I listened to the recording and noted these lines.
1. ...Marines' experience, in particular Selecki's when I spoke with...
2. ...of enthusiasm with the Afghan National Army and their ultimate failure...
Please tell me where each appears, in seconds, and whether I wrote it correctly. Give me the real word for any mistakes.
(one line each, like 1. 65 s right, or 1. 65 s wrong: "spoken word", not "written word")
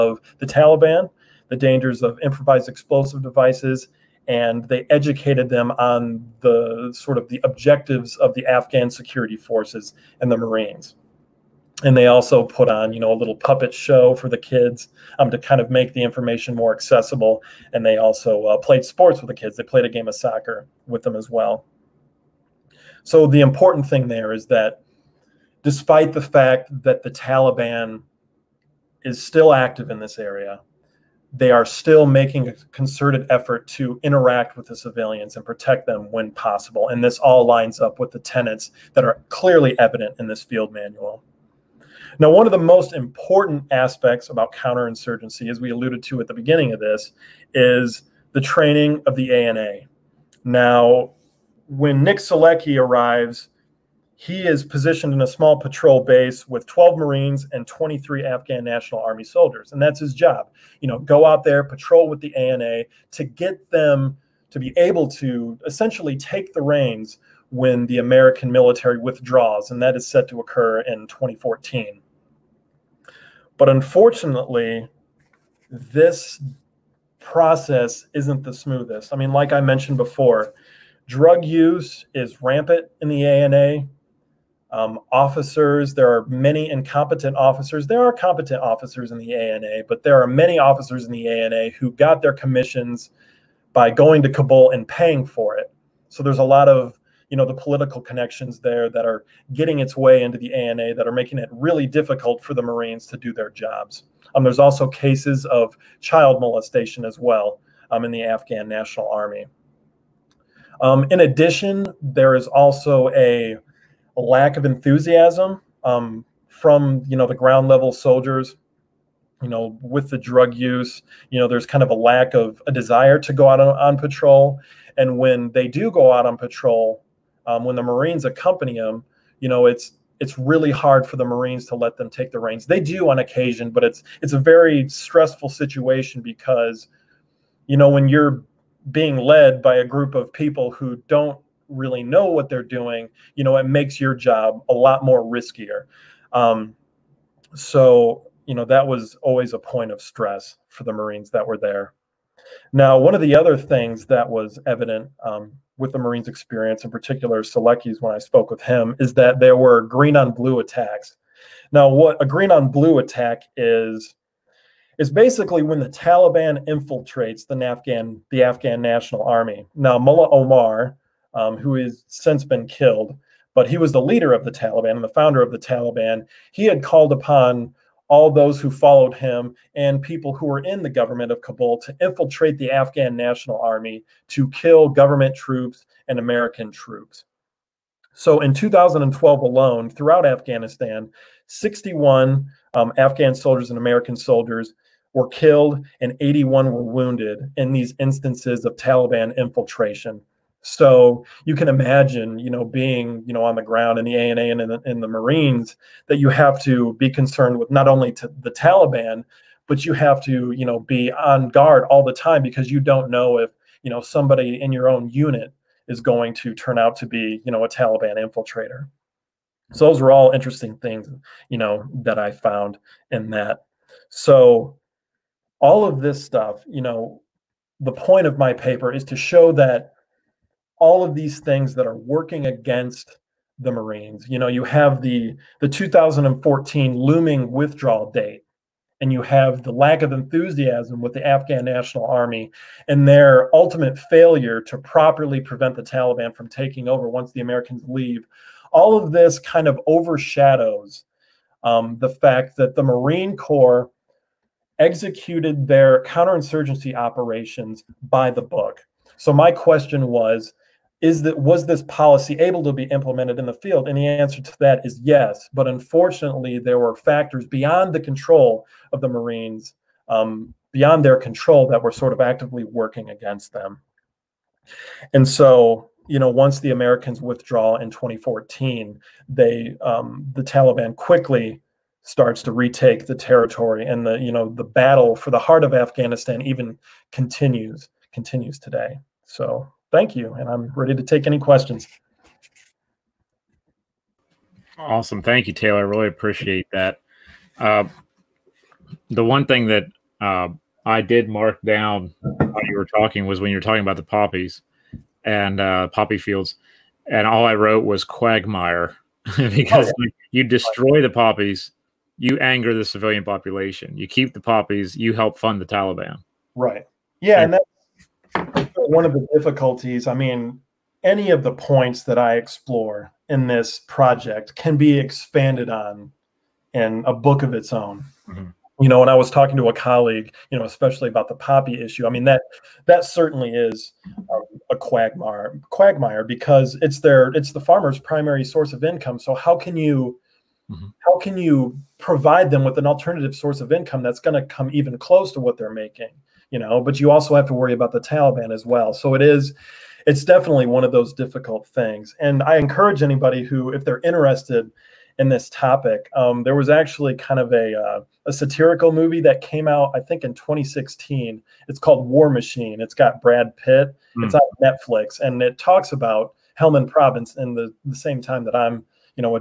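1. 155 s right
2. 240 s right.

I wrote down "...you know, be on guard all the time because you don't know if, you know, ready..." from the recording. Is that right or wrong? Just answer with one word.
wrong.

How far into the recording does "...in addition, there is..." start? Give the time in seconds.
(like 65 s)
111 s.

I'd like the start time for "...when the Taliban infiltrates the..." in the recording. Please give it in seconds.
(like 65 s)
165 s.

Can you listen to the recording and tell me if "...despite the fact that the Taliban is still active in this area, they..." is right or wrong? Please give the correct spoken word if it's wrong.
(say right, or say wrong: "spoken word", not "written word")
right.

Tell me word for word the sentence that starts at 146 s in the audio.
Um, so, you know, that was always a point of stress for the Marines that were there.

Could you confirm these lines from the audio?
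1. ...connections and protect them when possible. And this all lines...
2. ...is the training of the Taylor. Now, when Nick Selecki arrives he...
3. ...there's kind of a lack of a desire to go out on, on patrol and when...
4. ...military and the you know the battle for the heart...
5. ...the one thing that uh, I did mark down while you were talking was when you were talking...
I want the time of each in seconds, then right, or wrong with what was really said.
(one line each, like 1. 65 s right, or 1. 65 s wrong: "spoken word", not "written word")
1. 34 s wrong: "civilians", not "connections"
2. 47 s wrong: "ANA", not "Taylor"
3. 121 s right
4. 283 s wrong: "territory", not "military"
5. 299 s right.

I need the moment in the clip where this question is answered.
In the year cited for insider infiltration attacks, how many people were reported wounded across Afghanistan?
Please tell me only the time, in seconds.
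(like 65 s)
196 s.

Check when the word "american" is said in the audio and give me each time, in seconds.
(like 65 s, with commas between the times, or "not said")
67 s, 186 s, 193 s, 247 s, 276 s.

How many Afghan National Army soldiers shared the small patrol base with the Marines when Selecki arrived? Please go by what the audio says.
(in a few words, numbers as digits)
23.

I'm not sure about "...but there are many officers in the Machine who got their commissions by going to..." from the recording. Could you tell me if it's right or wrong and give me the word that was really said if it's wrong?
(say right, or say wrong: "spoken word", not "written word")
wrong: "ANA", not "Machine".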